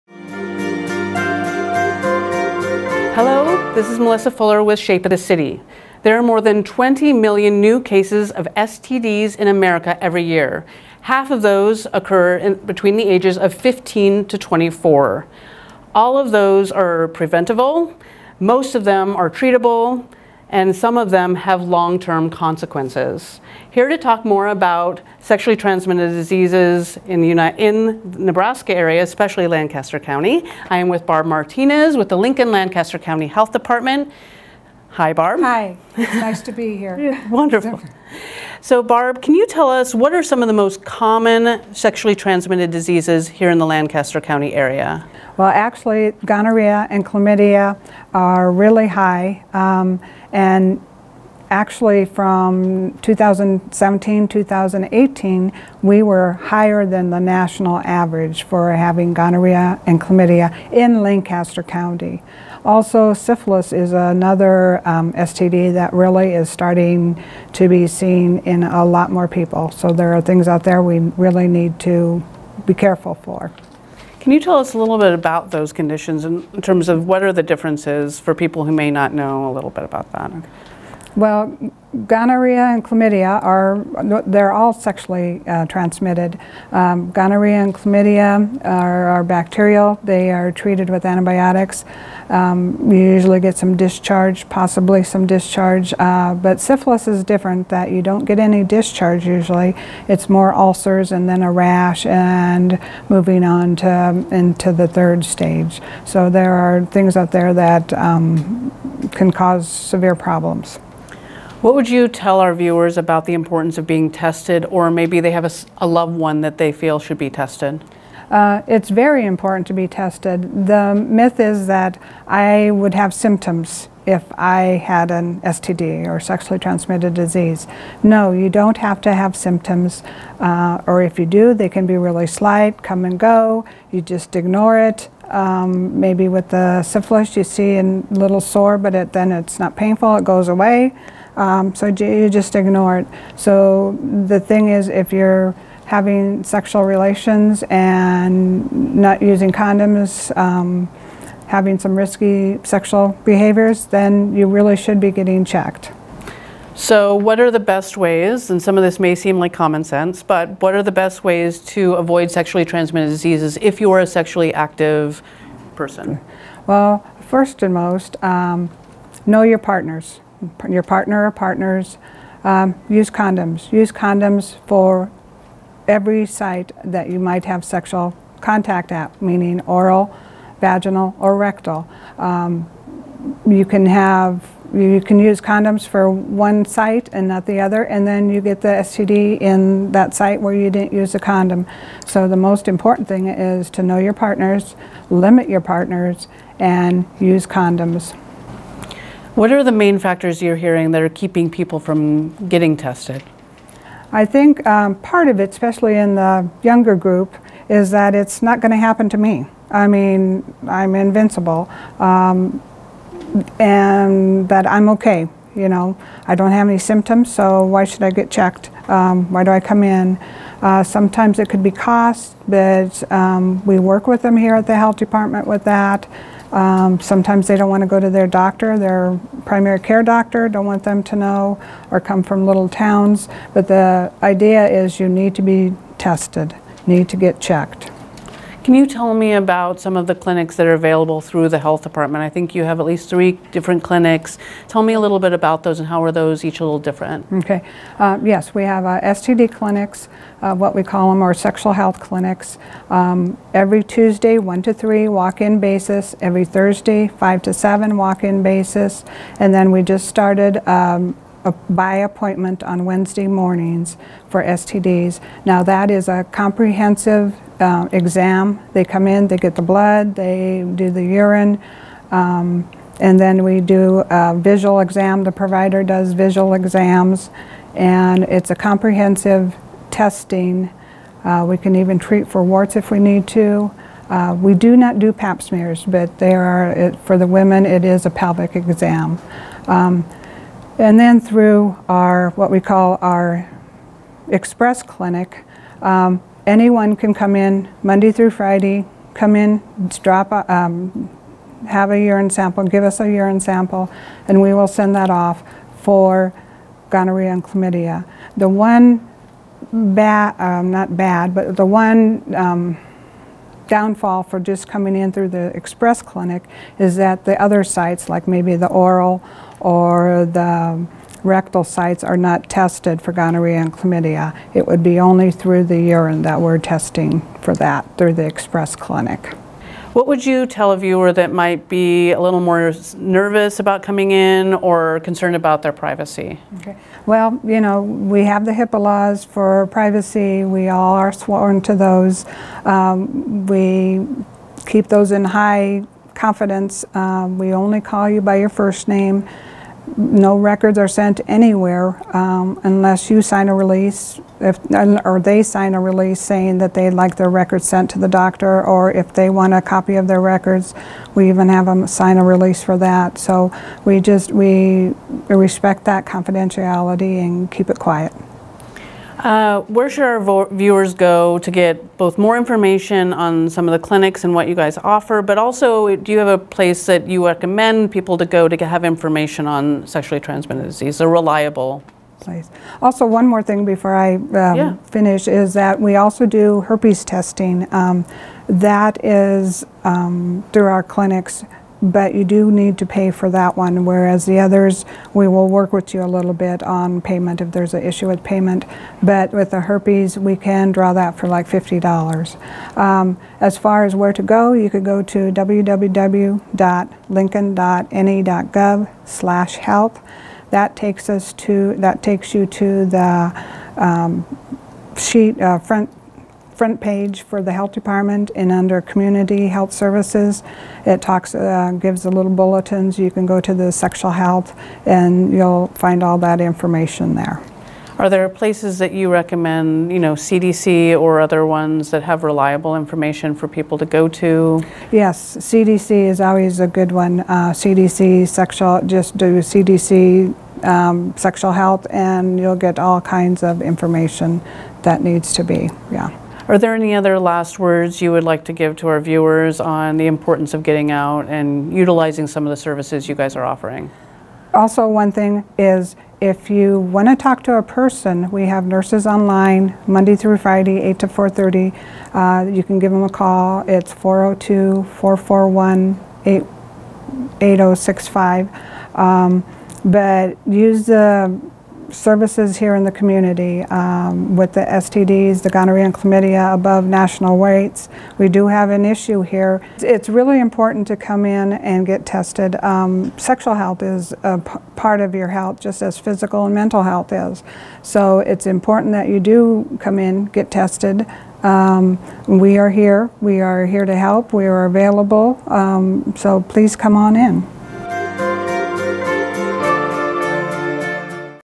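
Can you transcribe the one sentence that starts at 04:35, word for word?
The provider does visual exams, and it's a comprehensive testing.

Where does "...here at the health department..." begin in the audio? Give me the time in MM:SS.
03:44.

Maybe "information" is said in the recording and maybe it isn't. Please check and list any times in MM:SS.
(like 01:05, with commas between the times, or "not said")
06:12, 06:18, 07:06, 07:12, 07:23.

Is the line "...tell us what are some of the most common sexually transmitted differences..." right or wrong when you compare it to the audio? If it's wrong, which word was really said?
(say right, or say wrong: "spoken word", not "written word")
wrong: "diseases", not "differences".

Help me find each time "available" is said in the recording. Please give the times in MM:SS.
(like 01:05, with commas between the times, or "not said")
04:00, 08:14.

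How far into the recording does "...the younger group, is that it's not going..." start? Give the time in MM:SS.
03:26.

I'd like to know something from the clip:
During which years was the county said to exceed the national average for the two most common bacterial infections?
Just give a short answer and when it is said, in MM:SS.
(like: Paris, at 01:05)
2017 to 2018, at 00:52.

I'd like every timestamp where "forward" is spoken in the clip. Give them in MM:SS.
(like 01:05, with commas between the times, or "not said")
not said.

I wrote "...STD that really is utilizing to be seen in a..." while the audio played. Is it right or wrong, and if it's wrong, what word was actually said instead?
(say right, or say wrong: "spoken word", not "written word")
wrong: "starting", not "utilizing".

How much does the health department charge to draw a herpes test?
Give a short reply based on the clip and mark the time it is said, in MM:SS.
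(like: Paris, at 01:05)
$50, at 06:41.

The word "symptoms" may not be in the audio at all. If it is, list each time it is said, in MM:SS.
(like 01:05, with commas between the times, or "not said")
02:03, 02:09, 03:36.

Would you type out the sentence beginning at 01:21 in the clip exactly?
Well, gonorrhea and chlamydia are, they're all sexually uh, transmitted.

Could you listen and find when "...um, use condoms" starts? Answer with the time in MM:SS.
02:52.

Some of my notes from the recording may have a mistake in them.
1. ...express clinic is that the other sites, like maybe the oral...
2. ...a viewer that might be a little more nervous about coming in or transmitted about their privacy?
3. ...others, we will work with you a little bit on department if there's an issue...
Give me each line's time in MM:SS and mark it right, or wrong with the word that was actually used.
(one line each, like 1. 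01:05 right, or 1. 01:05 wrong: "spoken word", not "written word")
1. 05:15 right
2. 05:30 wrong: "concerned", not "transmitted"
3. 06:34 wrong: "payment", not "department".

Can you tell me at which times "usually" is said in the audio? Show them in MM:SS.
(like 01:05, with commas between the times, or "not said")
01:32, 01:39.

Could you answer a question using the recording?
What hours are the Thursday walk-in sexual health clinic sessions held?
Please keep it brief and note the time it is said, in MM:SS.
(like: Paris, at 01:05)
5 to 7, at 04:17.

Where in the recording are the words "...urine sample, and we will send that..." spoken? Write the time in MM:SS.
05:03.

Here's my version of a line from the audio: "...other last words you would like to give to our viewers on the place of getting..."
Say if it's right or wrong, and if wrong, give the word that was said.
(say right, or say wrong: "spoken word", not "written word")
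wrong: "importance", not "place".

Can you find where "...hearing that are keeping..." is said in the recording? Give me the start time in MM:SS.
03:20.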